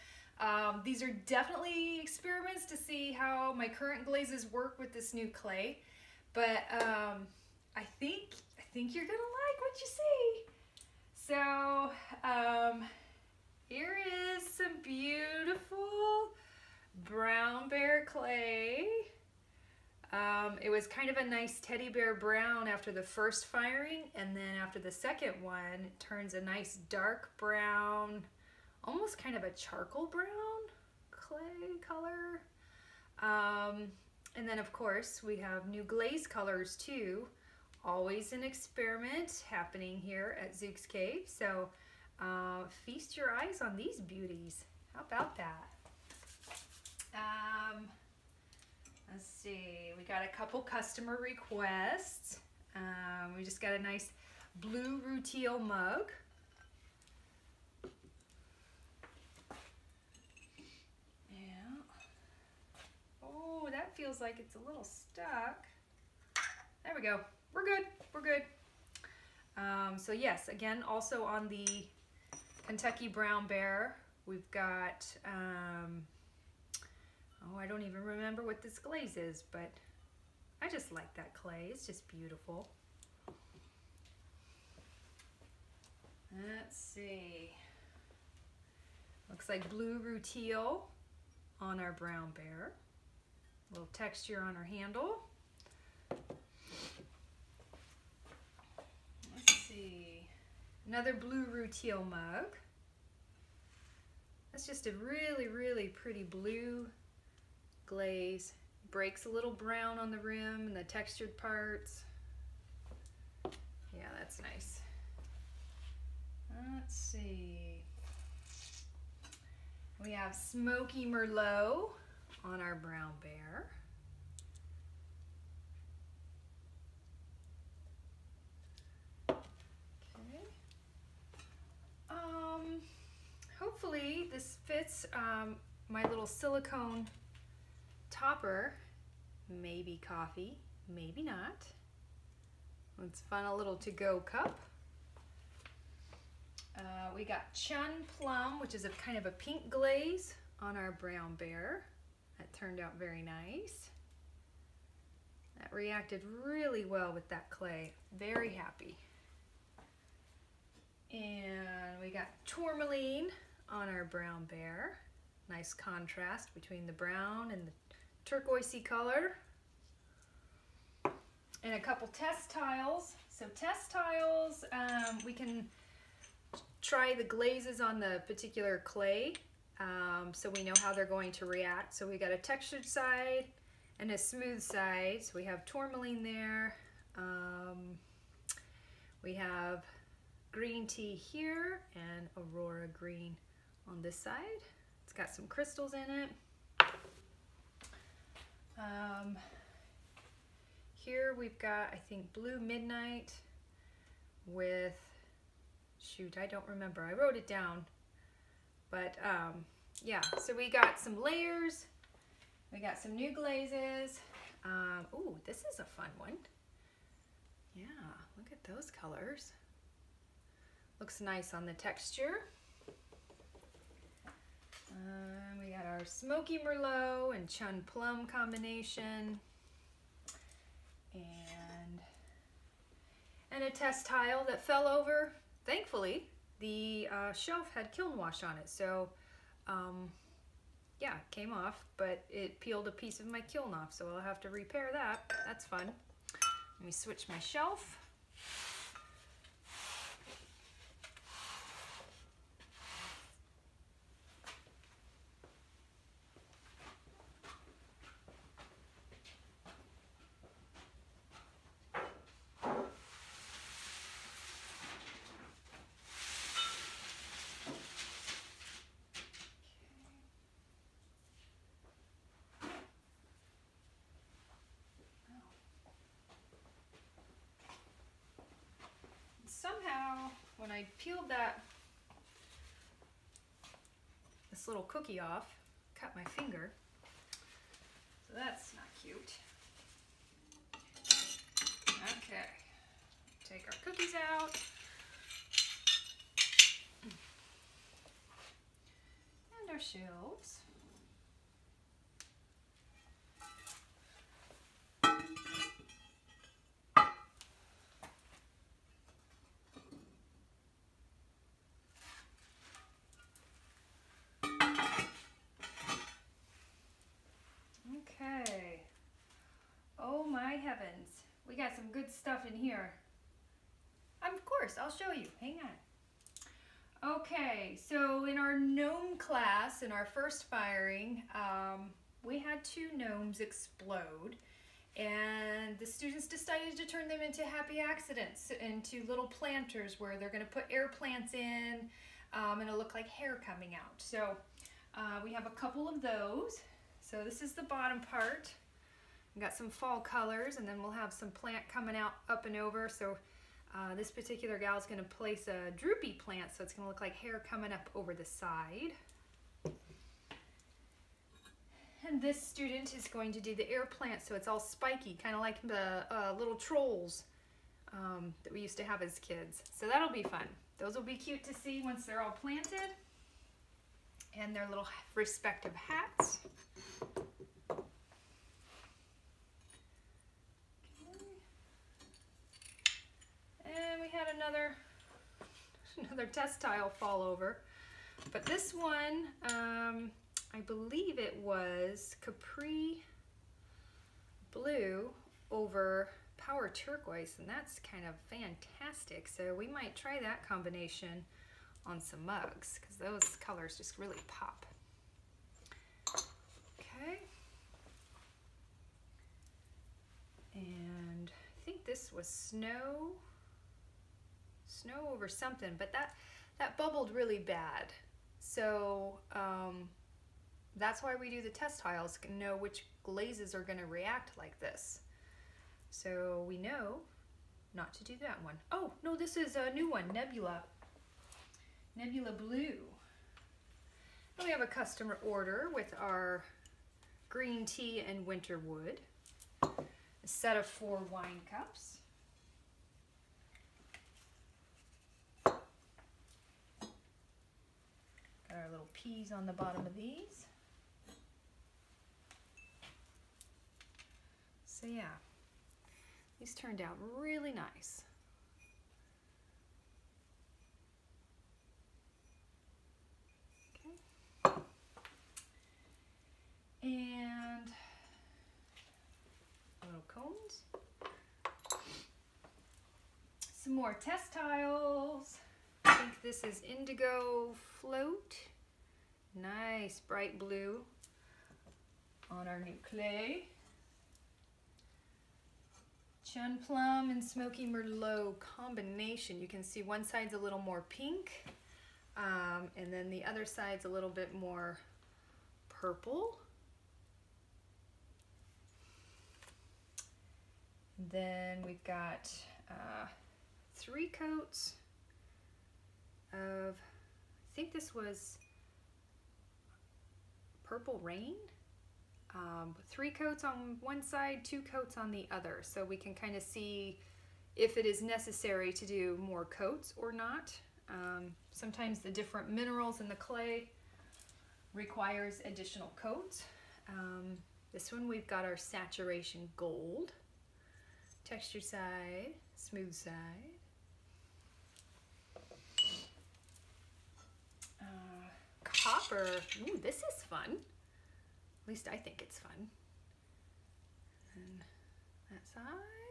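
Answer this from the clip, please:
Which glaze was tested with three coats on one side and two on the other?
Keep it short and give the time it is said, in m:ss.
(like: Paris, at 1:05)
Purple Rain, at 8:30.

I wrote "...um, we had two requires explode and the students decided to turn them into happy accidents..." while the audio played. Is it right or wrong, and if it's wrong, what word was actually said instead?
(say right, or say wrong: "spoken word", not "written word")
wrong: "gnomes", not "requires".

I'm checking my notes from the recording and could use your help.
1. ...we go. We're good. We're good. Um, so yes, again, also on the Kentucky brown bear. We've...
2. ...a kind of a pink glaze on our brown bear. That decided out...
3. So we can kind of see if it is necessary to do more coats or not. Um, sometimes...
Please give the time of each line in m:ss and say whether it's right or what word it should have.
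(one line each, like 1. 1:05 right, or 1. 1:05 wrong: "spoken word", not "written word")
1. 1:06 right
2. 2:28 wrong: "turned", not "decided"
3. 8:35 right.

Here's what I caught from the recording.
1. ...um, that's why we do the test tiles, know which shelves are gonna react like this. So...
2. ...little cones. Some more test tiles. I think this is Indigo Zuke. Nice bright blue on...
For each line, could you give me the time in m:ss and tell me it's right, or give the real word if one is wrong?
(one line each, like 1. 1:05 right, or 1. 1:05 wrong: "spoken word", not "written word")
1. 6:59 wrong: "glazes", not "shelves"
2. 7:49 wrong: "Float", not "Zuke".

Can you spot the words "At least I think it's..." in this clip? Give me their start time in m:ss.
9:01.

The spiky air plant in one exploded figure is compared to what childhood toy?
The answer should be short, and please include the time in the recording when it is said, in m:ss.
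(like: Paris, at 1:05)
Trolls, at 6:06.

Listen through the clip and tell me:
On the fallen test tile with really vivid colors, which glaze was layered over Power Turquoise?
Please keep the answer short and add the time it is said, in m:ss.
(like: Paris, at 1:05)
Capri Blue, at 6:32.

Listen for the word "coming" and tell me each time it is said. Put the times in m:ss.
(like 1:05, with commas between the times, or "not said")
5:43, 5:51, 5:57.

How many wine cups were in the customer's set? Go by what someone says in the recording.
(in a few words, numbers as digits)
4.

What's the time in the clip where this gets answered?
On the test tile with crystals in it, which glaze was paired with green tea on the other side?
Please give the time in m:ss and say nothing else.
3:12.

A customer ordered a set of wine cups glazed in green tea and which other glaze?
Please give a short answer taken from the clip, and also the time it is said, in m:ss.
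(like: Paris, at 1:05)
Winter wood, at 7:18.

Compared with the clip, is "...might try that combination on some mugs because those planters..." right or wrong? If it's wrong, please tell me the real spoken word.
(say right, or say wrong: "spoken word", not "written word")
wrong: "colors", not "planters".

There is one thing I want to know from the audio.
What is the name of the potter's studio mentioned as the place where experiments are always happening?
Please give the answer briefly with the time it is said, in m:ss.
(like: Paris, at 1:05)
Zuke's Cave, at 0:40.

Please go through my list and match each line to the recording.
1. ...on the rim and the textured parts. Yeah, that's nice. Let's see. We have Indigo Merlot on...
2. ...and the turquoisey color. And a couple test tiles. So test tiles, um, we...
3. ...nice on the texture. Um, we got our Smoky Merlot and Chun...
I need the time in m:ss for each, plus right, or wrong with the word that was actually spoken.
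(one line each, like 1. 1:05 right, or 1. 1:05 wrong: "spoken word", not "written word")
1. 1:49 wrong: "Smoky", not "Indigo"
2. 2:47 right
3. 3:41 right.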